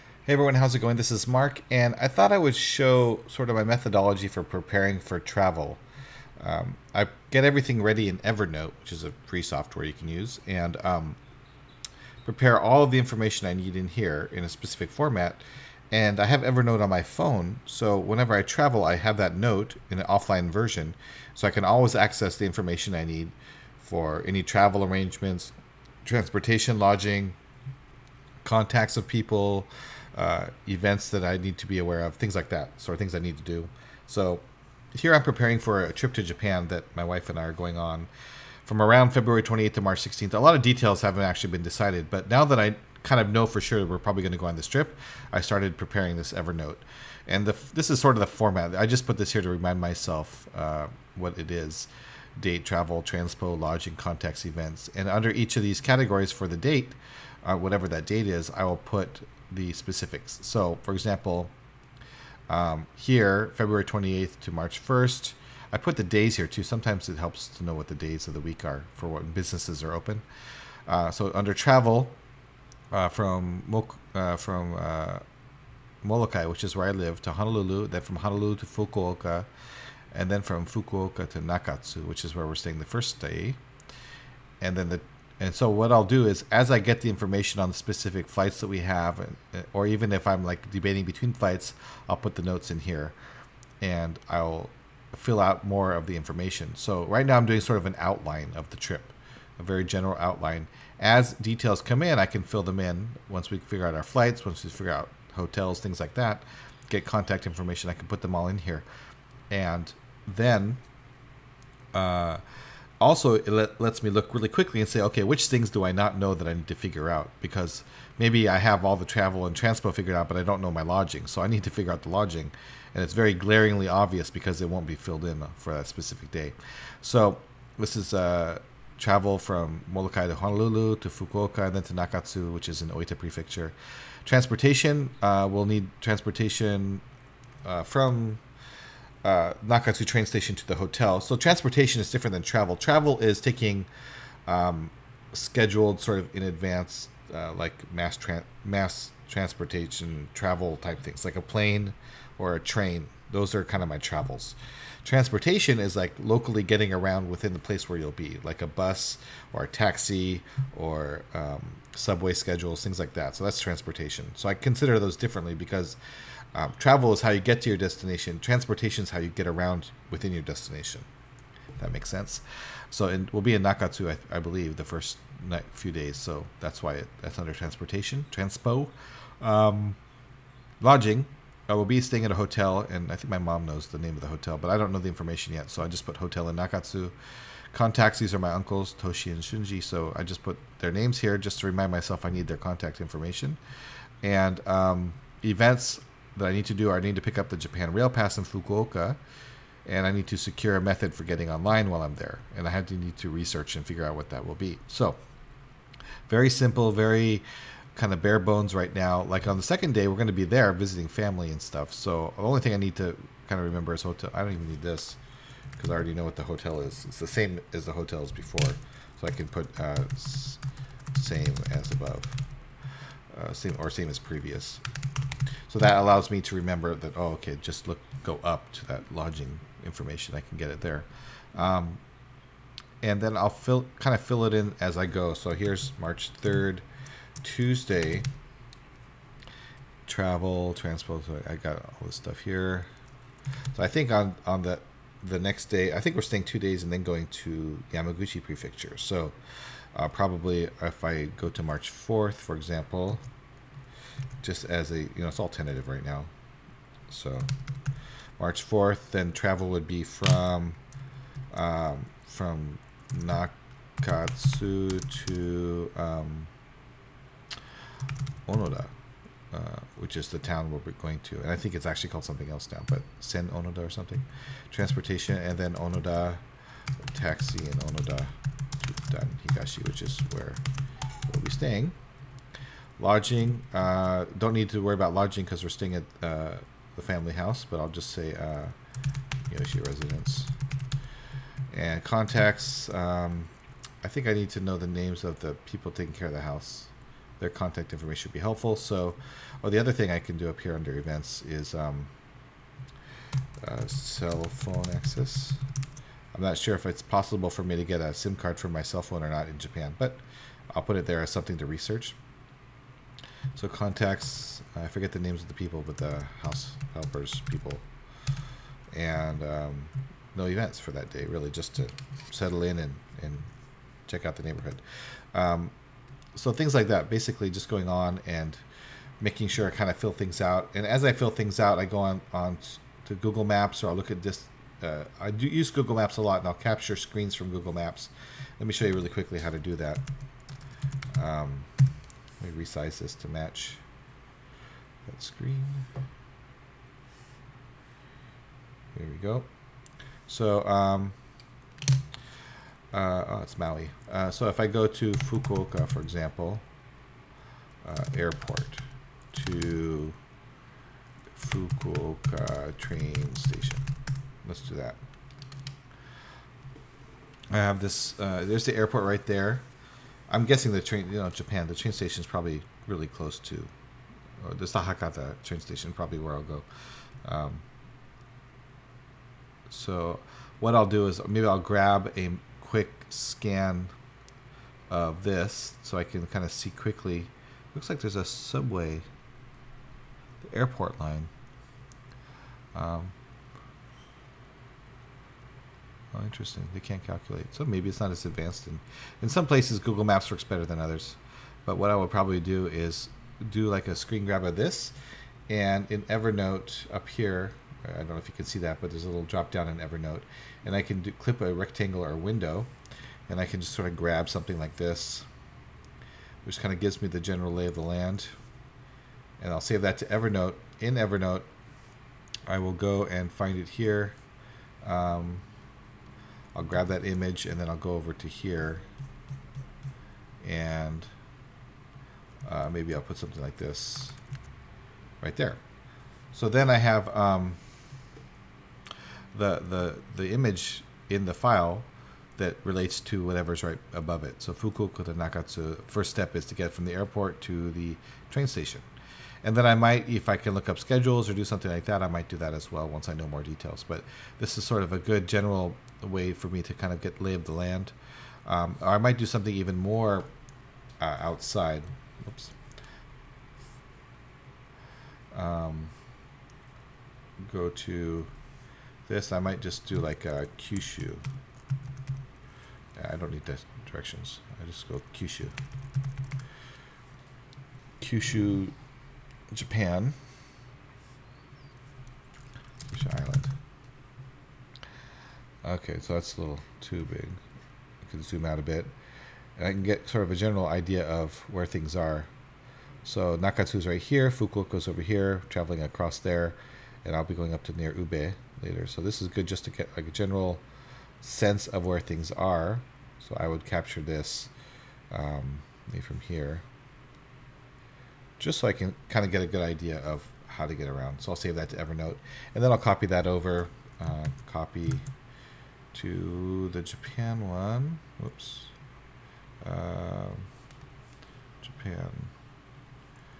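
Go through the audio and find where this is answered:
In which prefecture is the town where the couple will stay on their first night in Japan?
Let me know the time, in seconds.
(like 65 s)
132 s.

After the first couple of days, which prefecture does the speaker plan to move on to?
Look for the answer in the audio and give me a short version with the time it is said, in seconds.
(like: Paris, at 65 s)
Yamaguchi Prefecture, at 247 s.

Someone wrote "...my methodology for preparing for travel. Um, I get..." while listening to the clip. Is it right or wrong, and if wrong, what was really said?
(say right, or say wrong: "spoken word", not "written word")
right.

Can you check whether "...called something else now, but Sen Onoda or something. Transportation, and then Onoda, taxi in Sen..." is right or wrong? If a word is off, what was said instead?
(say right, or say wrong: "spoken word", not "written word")
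wrong: "Onoda", not "Sen".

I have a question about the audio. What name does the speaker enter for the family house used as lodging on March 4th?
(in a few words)
Yoshi residence.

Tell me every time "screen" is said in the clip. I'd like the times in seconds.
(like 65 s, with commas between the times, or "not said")
336 s, 345 s, 403 s.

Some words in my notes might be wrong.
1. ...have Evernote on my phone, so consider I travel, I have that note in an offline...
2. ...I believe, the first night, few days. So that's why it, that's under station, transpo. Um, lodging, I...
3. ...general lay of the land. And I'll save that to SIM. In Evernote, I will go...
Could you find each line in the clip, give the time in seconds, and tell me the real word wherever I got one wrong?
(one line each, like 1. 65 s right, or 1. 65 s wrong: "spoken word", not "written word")
1. 16 s wrong: "whenever", not "consider"
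2. 174 s wrong: "transportation", not "station"
3. 417 s wrong: "Evernote", not "SIM".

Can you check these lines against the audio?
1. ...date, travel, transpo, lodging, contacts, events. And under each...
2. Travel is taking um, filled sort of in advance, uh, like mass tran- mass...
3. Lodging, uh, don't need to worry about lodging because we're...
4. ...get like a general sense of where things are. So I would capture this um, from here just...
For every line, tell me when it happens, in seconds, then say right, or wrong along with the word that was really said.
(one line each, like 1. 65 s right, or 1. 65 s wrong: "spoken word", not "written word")
1. 52 s right
2. 142 s wrong: "scheduled", not "filled"
3. 282 s right
4. 499 s right.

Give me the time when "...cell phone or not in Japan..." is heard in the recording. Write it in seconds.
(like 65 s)
308 s.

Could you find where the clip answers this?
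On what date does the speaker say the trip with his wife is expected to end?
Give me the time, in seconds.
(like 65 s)
39 s.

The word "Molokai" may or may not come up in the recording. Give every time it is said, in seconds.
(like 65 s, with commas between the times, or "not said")
76 s, 129 s.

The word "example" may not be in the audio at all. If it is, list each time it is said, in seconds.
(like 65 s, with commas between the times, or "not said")
60 s, 252 s, 355 s.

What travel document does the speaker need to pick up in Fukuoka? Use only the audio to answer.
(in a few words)
Japan Rail Pass.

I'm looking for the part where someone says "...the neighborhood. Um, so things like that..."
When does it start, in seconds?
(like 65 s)
324 s.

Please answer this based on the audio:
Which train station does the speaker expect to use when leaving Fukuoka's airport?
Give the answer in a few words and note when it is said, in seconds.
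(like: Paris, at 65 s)
Hakata train station, at 374 s.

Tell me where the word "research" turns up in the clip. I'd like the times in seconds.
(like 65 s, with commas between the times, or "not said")
203 s, 311 s.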